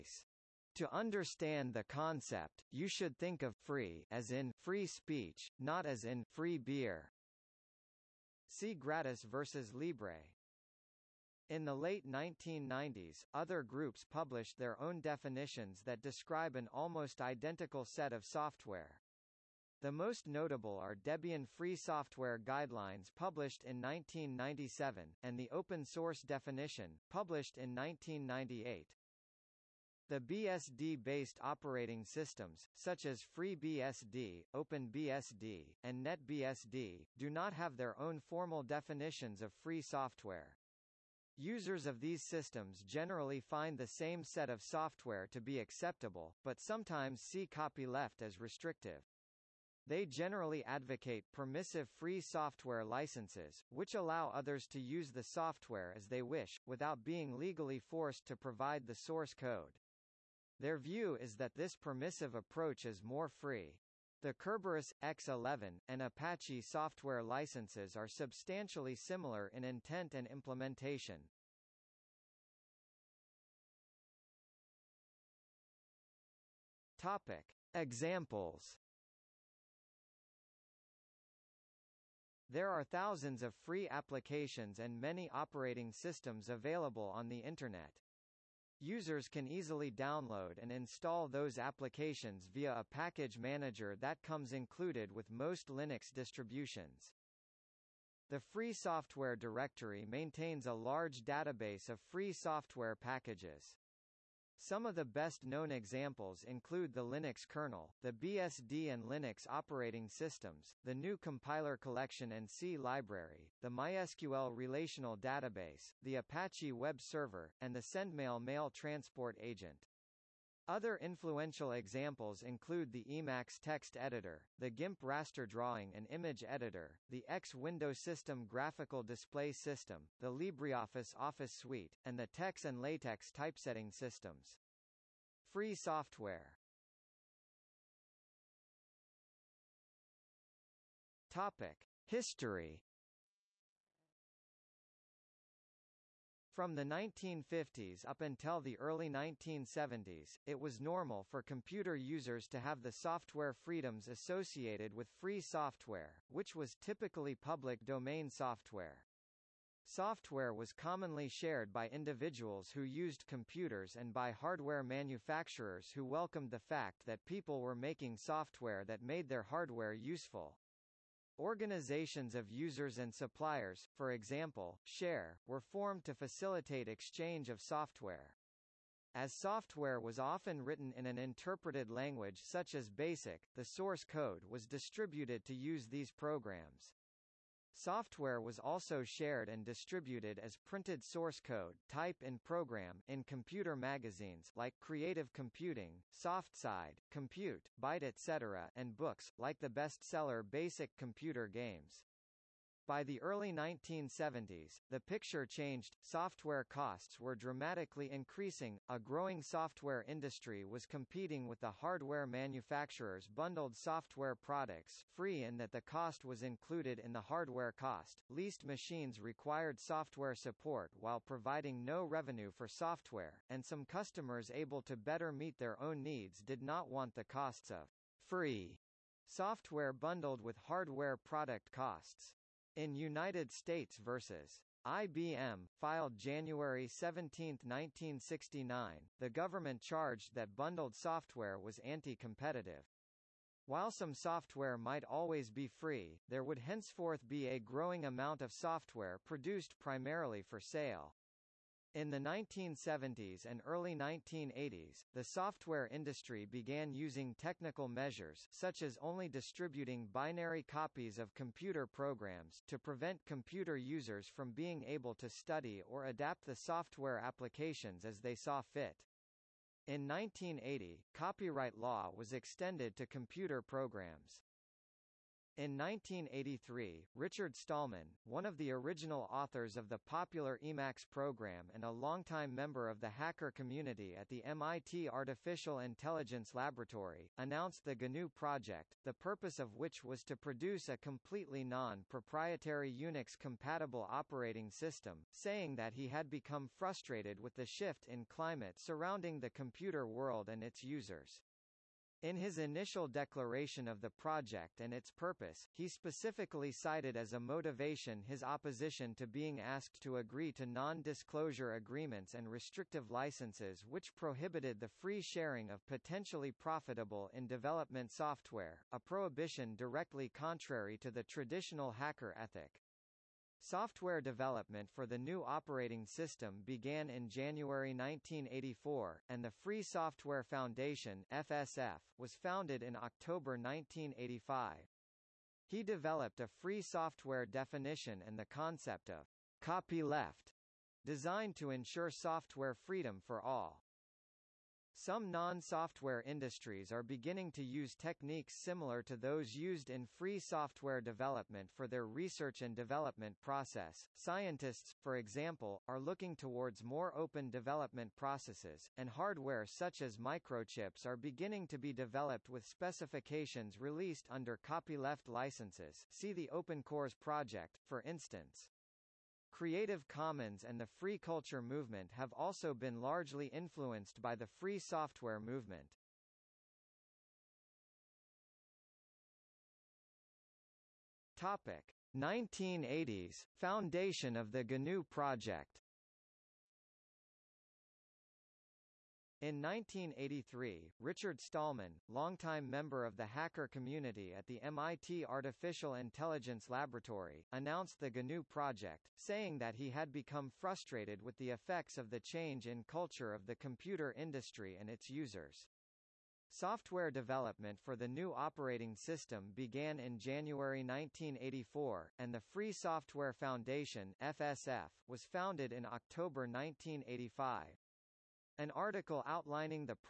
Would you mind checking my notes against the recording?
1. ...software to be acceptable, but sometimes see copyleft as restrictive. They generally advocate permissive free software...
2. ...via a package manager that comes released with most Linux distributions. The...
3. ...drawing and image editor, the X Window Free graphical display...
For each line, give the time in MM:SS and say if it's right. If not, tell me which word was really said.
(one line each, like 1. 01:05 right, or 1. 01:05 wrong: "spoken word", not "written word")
1. 00:44 right
2. 01:32 wrong: "included", not "released"
3. 02:05 wrong: "System", not "Free".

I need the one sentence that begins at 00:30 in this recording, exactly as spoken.
The BSD-based operating systems, such as FreeBSD, OpenBSD, and NetBSD, do not have their own formal definitions of free software.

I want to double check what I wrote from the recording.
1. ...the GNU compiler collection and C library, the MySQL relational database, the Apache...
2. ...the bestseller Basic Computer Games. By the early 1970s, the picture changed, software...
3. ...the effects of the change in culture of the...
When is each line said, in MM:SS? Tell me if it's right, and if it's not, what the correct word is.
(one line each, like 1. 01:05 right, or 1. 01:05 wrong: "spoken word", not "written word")
1. 01:50 right
2. 03:19 right
3. 06:41 right.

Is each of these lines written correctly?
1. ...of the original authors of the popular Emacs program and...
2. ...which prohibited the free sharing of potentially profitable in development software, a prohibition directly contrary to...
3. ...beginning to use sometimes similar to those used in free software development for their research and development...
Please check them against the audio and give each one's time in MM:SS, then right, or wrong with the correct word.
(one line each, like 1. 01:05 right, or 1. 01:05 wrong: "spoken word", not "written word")
1. 04:38 right
2. 05:13 right
3. 05:47 wrong: "techniques", not "sometimes".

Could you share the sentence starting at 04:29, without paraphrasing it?
In 1980, copyright law was extended to computer programs.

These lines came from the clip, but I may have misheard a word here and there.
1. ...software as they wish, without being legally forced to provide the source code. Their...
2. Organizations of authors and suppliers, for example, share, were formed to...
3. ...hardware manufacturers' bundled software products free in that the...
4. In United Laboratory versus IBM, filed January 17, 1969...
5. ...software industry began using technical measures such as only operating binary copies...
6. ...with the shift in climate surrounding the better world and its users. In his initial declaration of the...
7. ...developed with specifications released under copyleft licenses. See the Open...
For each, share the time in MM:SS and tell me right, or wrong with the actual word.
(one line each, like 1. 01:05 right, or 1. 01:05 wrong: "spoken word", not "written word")
1. 00:55 right
2. 02:51 wrong: "users", not "authors"
3. 03:31 right
4. 03:52 wrong: "States", not "Laboratory"
5. 04:15 wrong: "distributing", not "operating"
6. 04:57 wrong: "computer", not "better"
7. 06:01 right.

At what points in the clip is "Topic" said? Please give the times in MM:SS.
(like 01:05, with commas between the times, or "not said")
01:16, 02:21, 06:21.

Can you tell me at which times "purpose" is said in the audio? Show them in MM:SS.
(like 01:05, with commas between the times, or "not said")
04:49, 05:05.